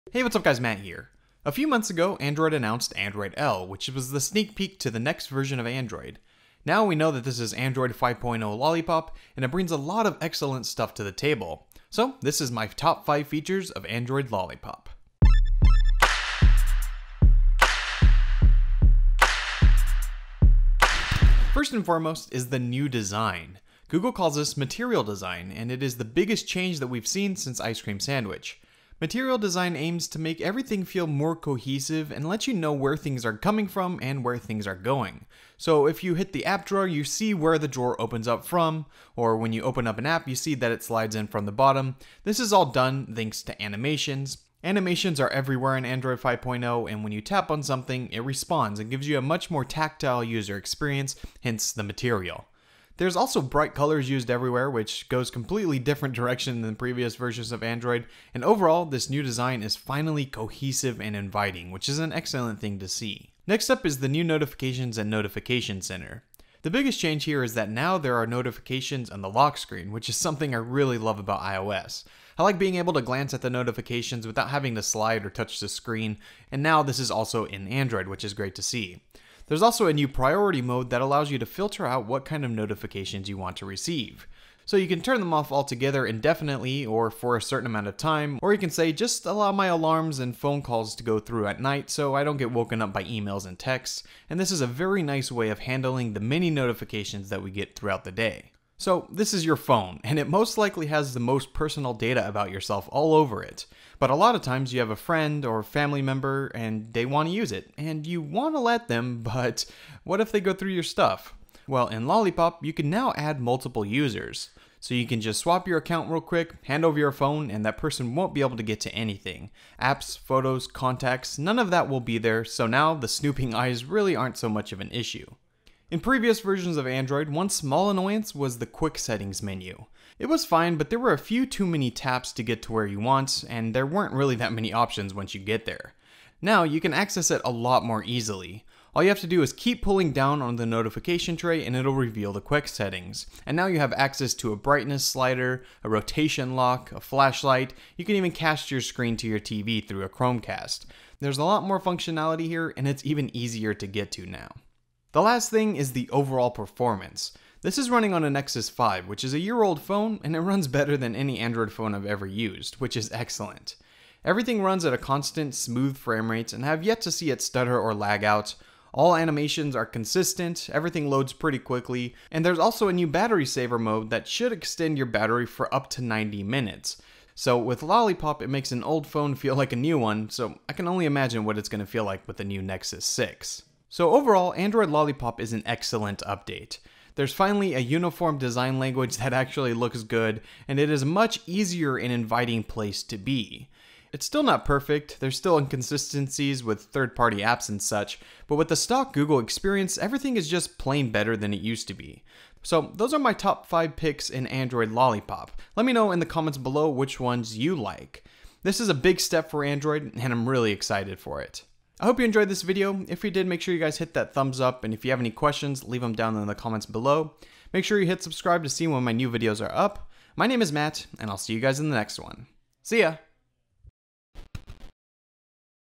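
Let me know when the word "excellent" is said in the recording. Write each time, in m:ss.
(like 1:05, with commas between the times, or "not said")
0:10, 1:02, 2:43, 3:05.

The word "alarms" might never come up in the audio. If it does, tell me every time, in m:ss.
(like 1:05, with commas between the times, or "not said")
1:29.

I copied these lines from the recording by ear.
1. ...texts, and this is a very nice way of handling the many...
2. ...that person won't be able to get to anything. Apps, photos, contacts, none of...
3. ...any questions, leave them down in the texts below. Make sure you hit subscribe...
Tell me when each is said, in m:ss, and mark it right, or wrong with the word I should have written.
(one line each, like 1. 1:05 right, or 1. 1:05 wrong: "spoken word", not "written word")
1. 1:33 right
2. 1:57 right
3. 3:35 wrong: "comments", not "texts".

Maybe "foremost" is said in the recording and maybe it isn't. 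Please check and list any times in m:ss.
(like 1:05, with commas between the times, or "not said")
0:21.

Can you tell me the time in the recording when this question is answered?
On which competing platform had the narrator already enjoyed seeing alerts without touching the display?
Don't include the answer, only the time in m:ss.
1:11.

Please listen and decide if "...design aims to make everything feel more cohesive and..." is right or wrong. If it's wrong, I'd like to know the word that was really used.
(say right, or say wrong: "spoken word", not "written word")
right.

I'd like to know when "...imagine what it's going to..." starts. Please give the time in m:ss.
3:01.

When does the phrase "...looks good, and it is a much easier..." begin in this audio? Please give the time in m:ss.
3:09.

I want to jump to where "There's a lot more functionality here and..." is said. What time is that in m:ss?
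2:31.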